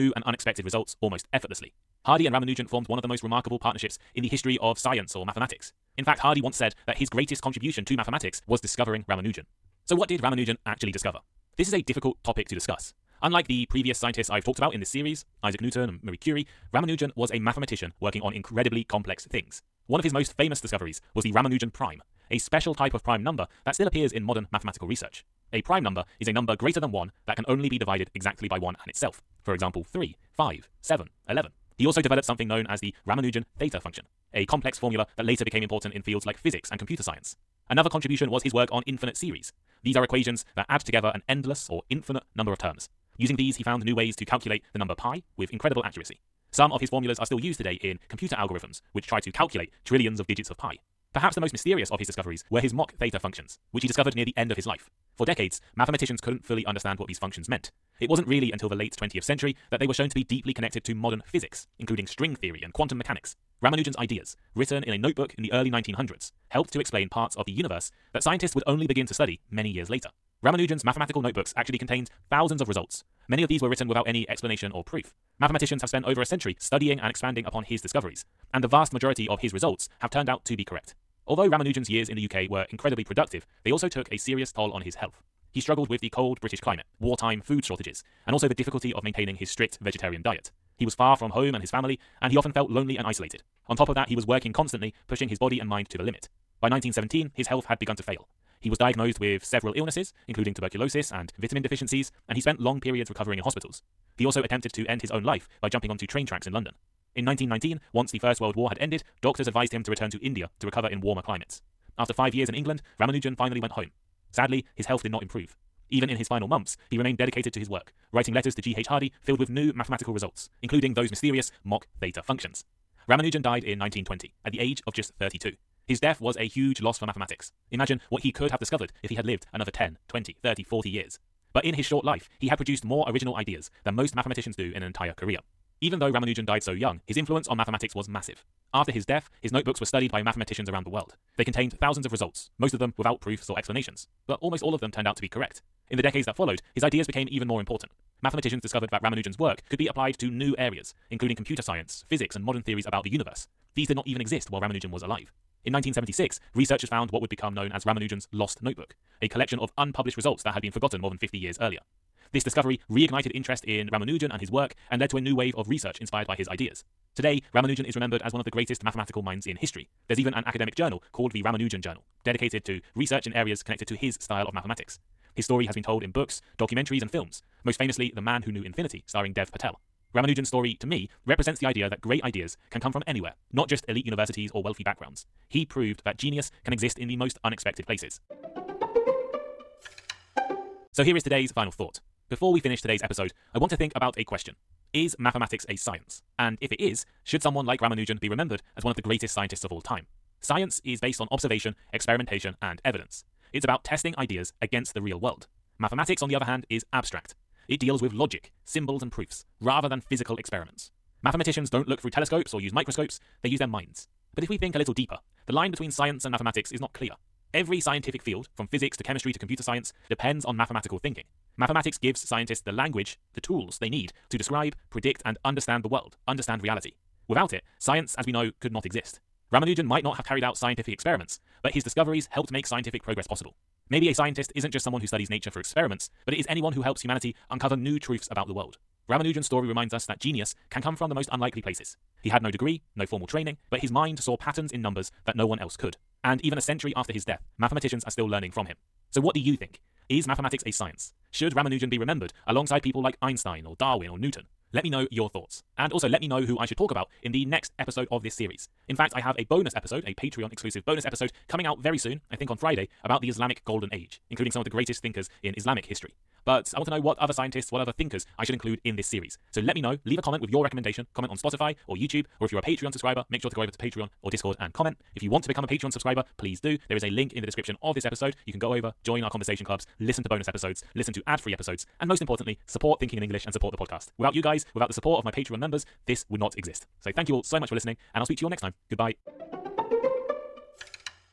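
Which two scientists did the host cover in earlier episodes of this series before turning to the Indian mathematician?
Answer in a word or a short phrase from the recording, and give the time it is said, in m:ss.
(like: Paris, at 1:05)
Isaac Newton and Marie Curie, at 0:15.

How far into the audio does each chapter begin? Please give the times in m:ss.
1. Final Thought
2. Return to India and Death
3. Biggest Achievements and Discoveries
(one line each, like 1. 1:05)
1. 3:07
2. 1:20
3. 0:09.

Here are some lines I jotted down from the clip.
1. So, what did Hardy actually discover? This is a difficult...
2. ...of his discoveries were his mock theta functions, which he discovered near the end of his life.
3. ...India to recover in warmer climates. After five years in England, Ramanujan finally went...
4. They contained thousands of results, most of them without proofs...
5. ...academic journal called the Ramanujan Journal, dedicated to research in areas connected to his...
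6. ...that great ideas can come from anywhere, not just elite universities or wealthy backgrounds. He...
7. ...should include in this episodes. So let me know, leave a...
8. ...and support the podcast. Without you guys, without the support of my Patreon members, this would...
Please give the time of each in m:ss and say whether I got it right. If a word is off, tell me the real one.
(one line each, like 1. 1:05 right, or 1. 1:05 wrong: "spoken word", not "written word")
1. 0:09 wrong: "Ramanujan", not "Hardy"
2. 0:51 right
3. 1:50 right
4. 2:21 right
5. 2:50 right
6. 3:01 right
7. 4:28 wrong: "series", not "episodes"
8. 4:43 right.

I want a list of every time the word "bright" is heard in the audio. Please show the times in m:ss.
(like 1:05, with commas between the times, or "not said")
not said.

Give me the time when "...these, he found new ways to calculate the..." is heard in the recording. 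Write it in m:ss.
0:43.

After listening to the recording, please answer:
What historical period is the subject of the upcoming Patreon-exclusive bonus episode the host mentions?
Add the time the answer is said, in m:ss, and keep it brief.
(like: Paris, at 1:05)
Islamic Golden Age, at 4:23.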